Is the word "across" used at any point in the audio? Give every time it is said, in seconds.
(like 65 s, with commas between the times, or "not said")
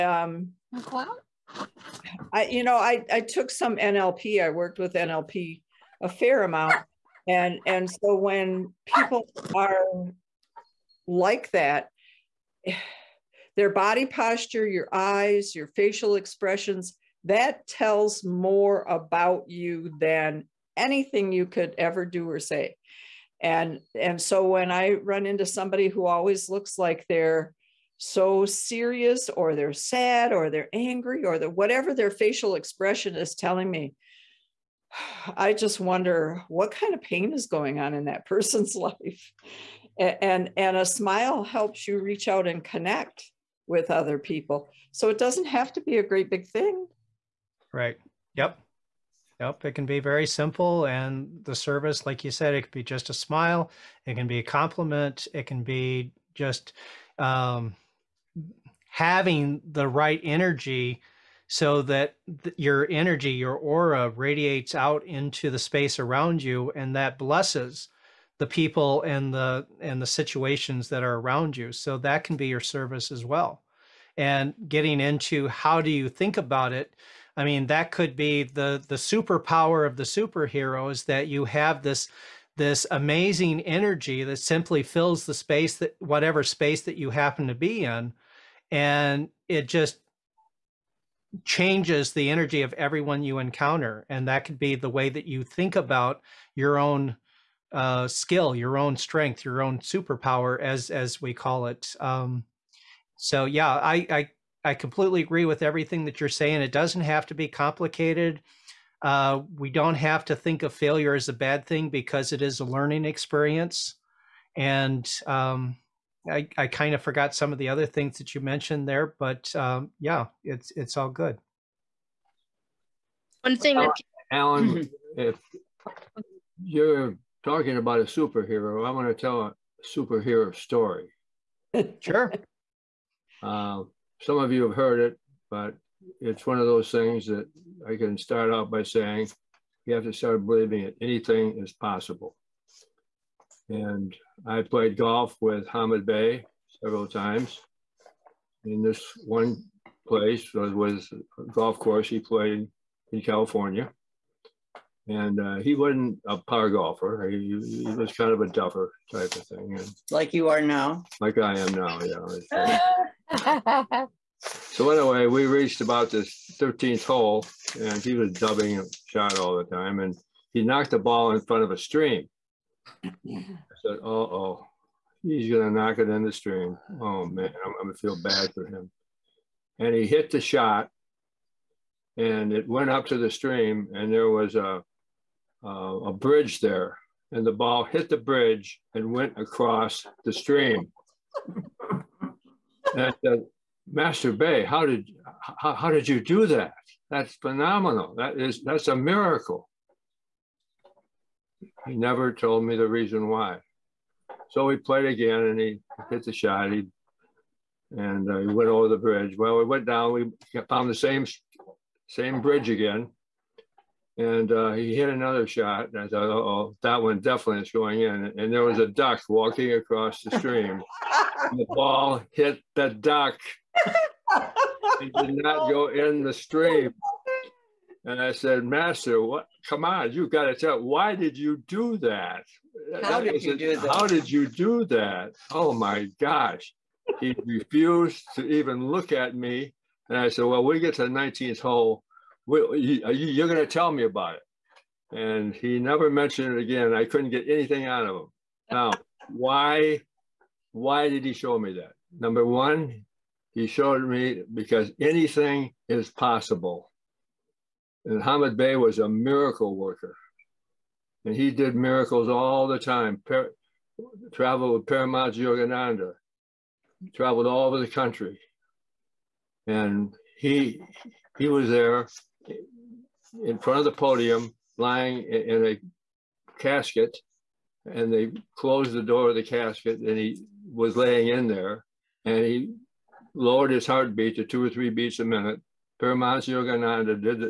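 189 s, 219 s.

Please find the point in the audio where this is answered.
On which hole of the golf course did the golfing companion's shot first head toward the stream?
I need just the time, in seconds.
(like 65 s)
166 s.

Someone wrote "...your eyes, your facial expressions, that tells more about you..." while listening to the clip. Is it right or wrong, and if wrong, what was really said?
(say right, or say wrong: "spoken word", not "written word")
right.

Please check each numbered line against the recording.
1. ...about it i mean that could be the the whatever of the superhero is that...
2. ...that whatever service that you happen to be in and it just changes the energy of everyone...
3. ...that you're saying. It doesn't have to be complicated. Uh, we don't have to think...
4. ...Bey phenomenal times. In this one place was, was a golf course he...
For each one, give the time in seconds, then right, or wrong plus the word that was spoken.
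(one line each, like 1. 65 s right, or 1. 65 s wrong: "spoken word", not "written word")
1. 76 s wrong: "superpower", not "whatever"
2. 85 s wrong: "space", not "service"
3. 106 s right
4. 146 s wrong: "several", not "phenomenal".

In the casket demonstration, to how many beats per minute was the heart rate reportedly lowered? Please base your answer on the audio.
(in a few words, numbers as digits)
2 or 3.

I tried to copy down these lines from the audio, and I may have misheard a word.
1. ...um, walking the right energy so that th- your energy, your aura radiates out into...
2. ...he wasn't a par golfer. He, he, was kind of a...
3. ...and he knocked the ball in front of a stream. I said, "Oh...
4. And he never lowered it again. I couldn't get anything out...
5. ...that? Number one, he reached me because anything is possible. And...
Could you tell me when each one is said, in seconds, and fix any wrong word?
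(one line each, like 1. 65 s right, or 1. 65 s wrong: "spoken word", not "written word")
1. 57 s wrong: "having", not "walking"
2. 155 s right
3. 169 s right
4. 245 s wrong: "mentioned", not "lowered"
5. 251 s wrong: "showed", not "reached".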